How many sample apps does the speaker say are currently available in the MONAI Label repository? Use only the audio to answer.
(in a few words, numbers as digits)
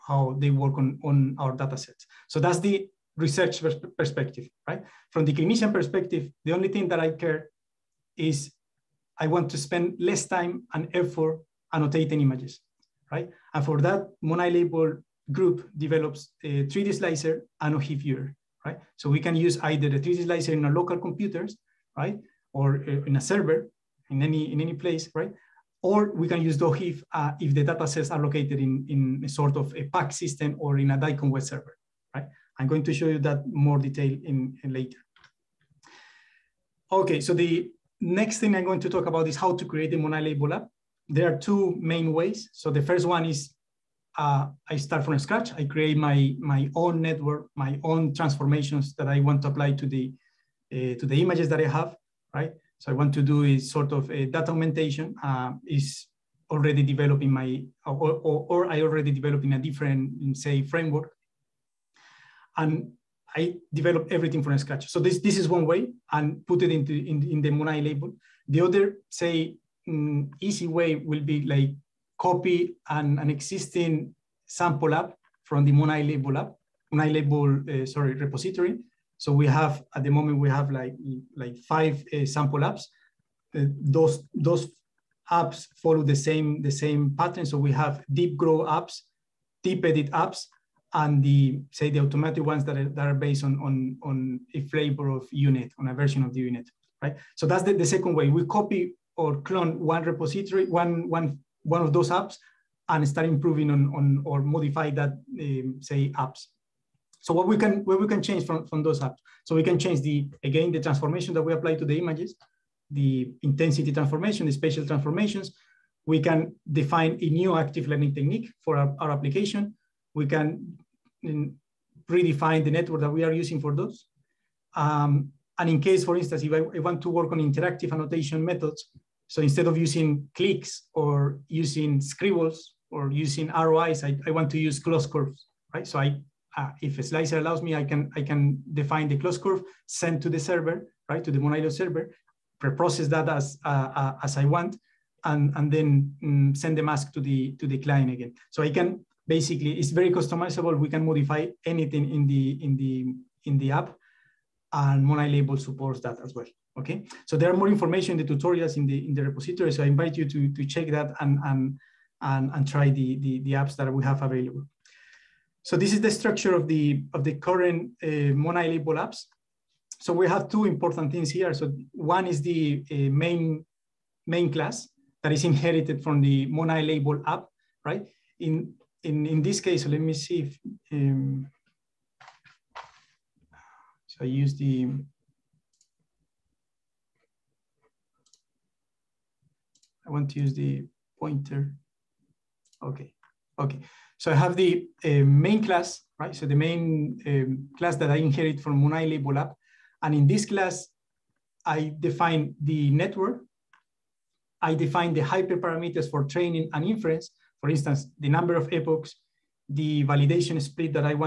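5.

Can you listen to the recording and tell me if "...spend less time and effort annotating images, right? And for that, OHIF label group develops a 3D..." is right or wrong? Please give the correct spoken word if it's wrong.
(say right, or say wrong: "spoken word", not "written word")
wrong: "Monai", not "OHIF".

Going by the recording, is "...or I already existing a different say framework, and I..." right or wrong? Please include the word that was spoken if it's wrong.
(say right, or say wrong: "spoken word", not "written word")
wrong: "developing", not "existing".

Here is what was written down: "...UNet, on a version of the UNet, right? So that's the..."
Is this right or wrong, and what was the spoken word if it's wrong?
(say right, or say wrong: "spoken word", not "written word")
right.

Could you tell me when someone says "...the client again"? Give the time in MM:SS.
02:27.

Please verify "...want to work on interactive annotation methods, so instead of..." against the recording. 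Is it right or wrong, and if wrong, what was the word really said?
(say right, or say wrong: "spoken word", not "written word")
right.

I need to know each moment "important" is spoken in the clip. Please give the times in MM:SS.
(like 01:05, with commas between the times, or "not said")
02:50.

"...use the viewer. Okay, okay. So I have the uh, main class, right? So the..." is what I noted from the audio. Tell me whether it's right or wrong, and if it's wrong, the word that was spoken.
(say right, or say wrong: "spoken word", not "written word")
wrong: "pointer", not "viewer".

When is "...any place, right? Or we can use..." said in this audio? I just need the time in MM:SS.
00:24.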